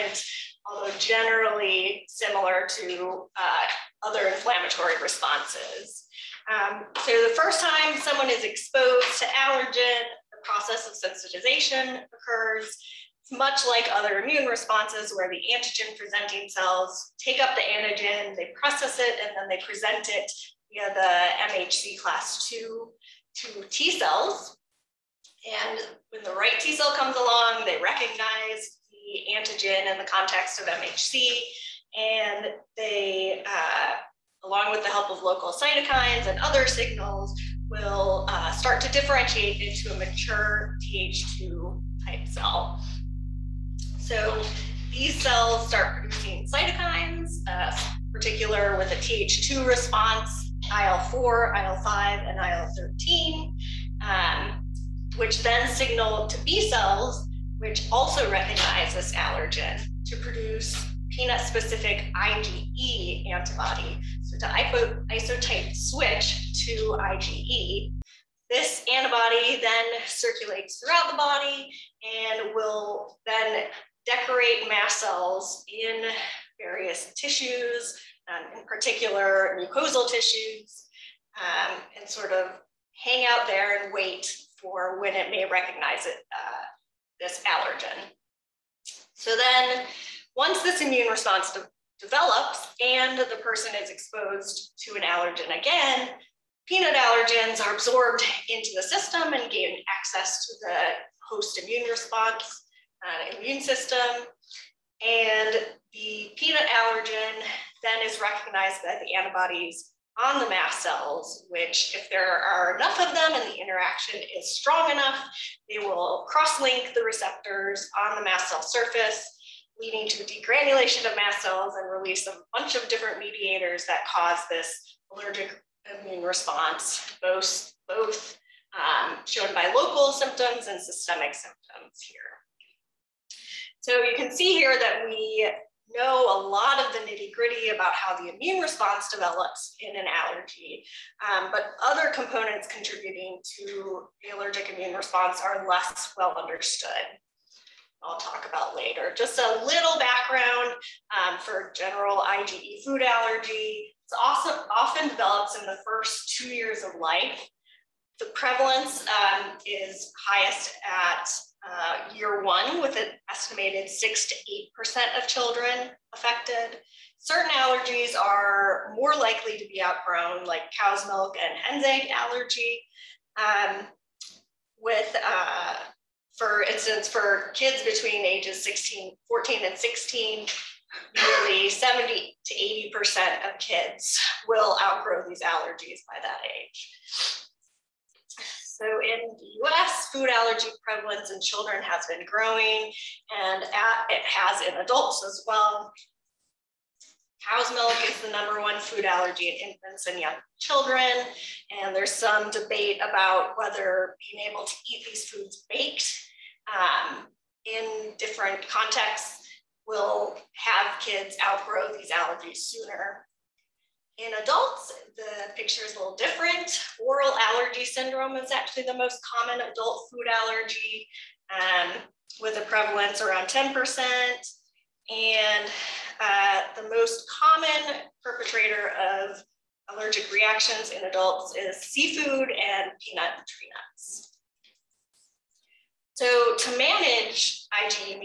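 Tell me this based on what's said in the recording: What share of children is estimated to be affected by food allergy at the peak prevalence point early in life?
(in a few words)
6 to 8%.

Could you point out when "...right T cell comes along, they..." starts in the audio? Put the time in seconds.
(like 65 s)
26 s.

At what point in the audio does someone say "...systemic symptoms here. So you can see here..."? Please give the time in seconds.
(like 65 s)
130 s.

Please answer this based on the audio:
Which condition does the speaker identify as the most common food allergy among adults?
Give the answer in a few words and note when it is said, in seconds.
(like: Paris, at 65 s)
Oral allergy syndrome, at 217 s.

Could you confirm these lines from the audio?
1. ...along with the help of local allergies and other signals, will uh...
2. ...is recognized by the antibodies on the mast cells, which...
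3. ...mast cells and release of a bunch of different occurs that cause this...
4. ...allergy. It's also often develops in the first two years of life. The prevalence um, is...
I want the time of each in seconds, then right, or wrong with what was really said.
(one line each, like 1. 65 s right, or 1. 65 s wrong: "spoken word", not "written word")
1. 34 s wrong: "cytokines", not "allergies"
2. 108 s right
3. 121 s wrong: "mediators", not "occurs"
4. 153 s right.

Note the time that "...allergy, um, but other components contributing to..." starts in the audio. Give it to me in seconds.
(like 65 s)
140 s.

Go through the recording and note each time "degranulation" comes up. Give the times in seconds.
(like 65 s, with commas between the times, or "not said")
120 s.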